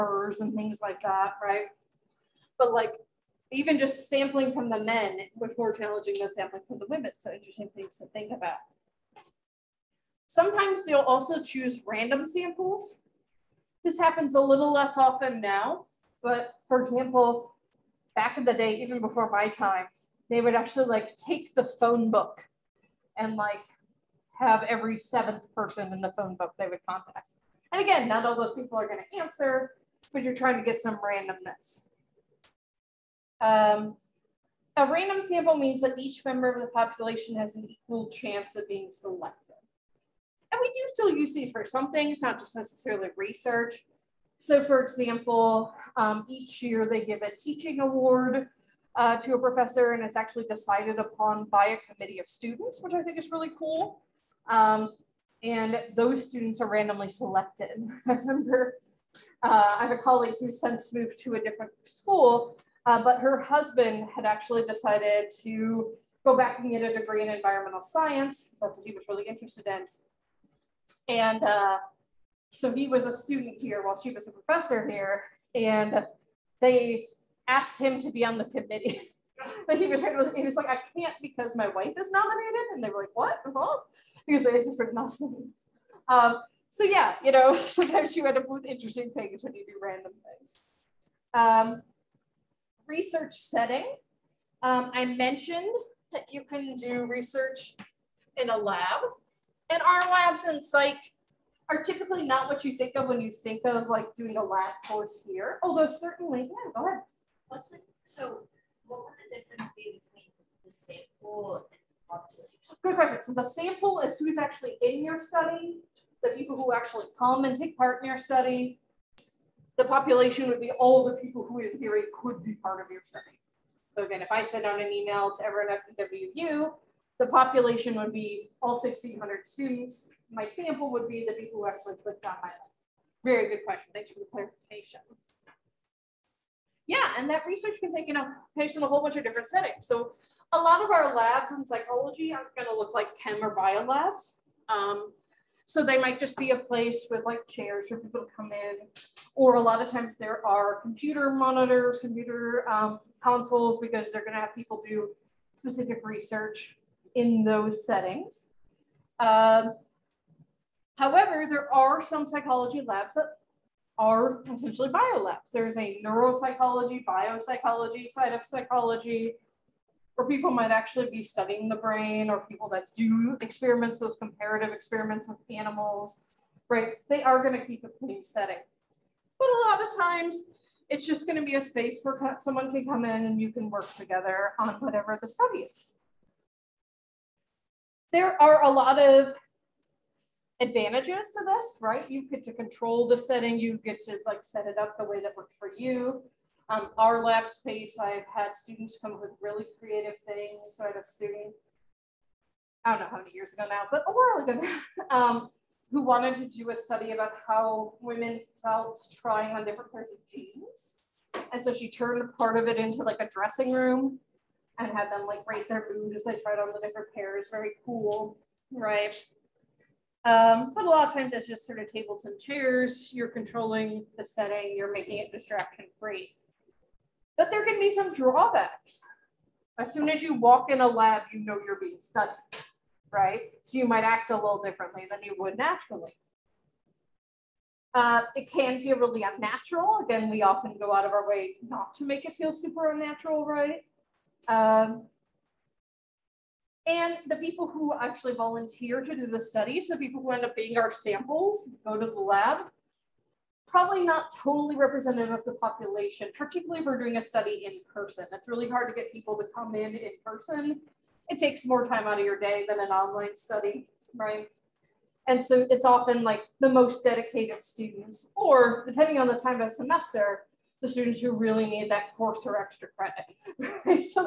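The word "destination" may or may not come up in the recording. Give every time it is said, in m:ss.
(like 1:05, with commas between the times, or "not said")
not said.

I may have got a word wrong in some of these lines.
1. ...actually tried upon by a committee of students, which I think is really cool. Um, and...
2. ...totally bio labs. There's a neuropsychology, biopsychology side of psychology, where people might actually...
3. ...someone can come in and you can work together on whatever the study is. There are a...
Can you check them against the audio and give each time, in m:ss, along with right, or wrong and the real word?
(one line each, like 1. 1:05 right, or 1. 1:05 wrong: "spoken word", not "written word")
1. 0:50 wrong: "decided", not "tried"
2. 2:44 wrong: "essentially", not "totally"
3. 3:02 right.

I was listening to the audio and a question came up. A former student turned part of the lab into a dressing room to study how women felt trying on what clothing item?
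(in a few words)
jeans.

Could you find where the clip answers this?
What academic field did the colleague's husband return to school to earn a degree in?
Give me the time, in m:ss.
1:07.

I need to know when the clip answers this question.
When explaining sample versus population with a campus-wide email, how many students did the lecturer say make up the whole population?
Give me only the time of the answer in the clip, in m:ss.
2:08.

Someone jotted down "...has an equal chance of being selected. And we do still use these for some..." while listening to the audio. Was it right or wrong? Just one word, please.
right.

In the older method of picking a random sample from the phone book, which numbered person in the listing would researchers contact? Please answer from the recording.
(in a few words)
every 7th person.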